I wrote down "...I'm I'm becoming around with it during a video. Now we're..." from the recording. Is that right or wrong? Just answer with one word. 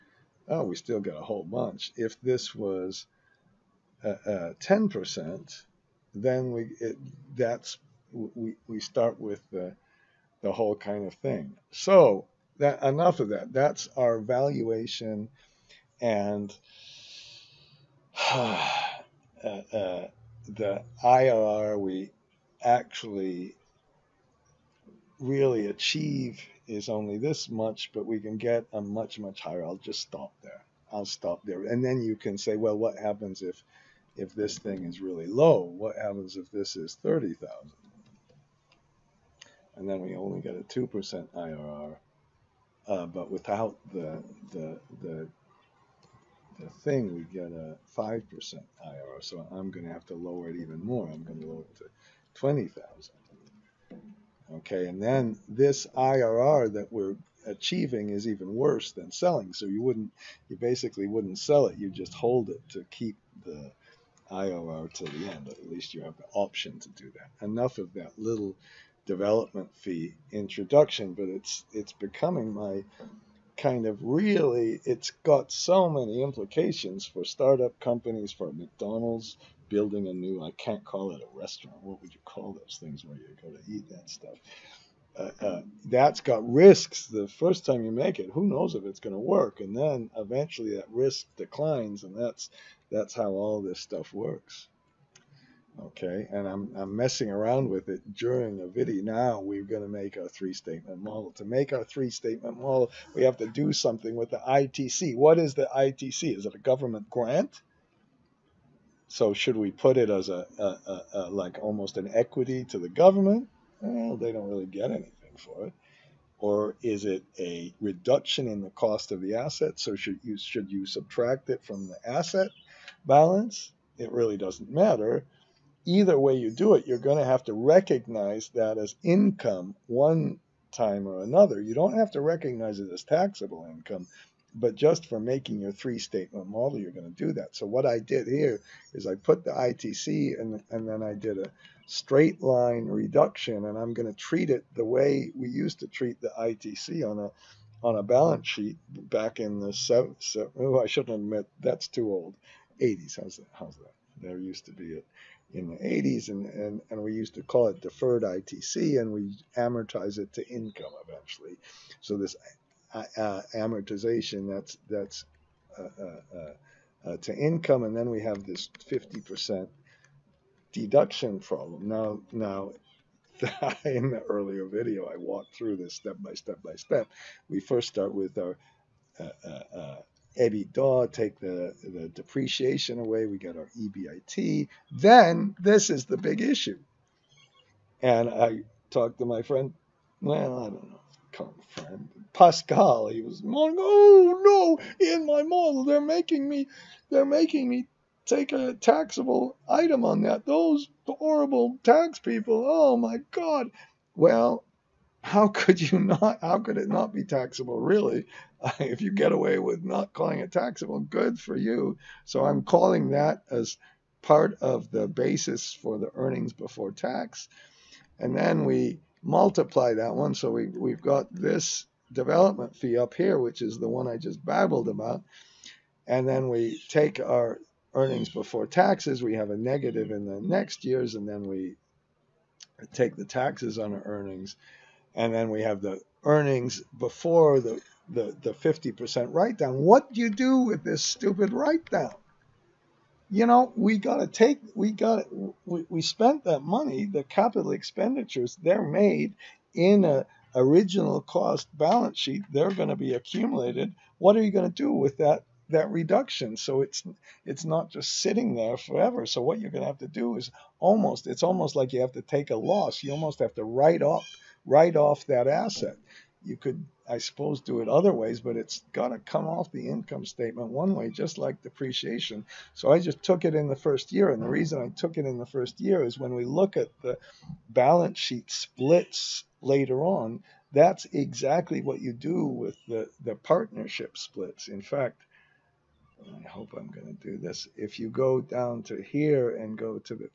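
wrong.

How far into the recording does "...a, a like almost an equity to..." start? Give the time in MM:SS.
01:50.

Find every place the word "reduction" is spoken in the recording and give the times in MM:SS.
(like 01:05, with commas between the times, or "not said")
01:57, 02:22, 04:15.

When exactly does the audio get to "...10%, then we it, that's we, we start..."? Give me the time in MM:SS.
00:04.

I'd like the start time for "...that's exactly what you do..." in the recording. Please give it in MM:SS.
04:40.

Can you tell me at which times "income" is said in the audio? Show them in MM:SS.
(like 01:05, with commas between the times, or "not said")
02:09, 02:13, 02:40, 02:47, 04:29.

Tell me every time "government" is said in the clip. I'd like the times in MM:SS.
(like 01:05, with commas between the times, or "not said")
01:46, 01:52.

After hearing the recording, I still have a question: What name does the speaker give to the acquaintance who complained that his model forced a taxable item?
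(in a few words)
Pascal.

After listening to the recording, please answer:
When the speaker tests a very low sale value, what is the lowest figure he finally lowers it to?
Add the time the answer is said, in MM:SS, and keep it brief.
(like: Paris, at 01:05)
20,000, at 00:52.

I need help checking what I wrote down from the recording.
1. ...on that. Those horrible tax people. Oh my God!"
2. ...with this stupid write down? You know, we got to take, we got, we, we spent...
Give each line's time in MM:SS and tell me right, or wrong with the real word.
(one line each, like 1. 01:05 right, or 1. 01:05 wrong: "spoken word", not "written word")
1. 03:20 right
2. 04:00 right.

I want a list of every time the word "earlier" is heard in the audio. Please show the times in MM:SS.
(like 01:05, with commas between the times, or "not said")
02:54.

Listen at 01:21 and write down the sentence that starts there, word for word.
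What would you call those things where you go to eat that stuff?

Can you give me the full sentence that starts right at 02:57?
We first start with our EBITDA, take the, the depreciation away, we get our EBIT.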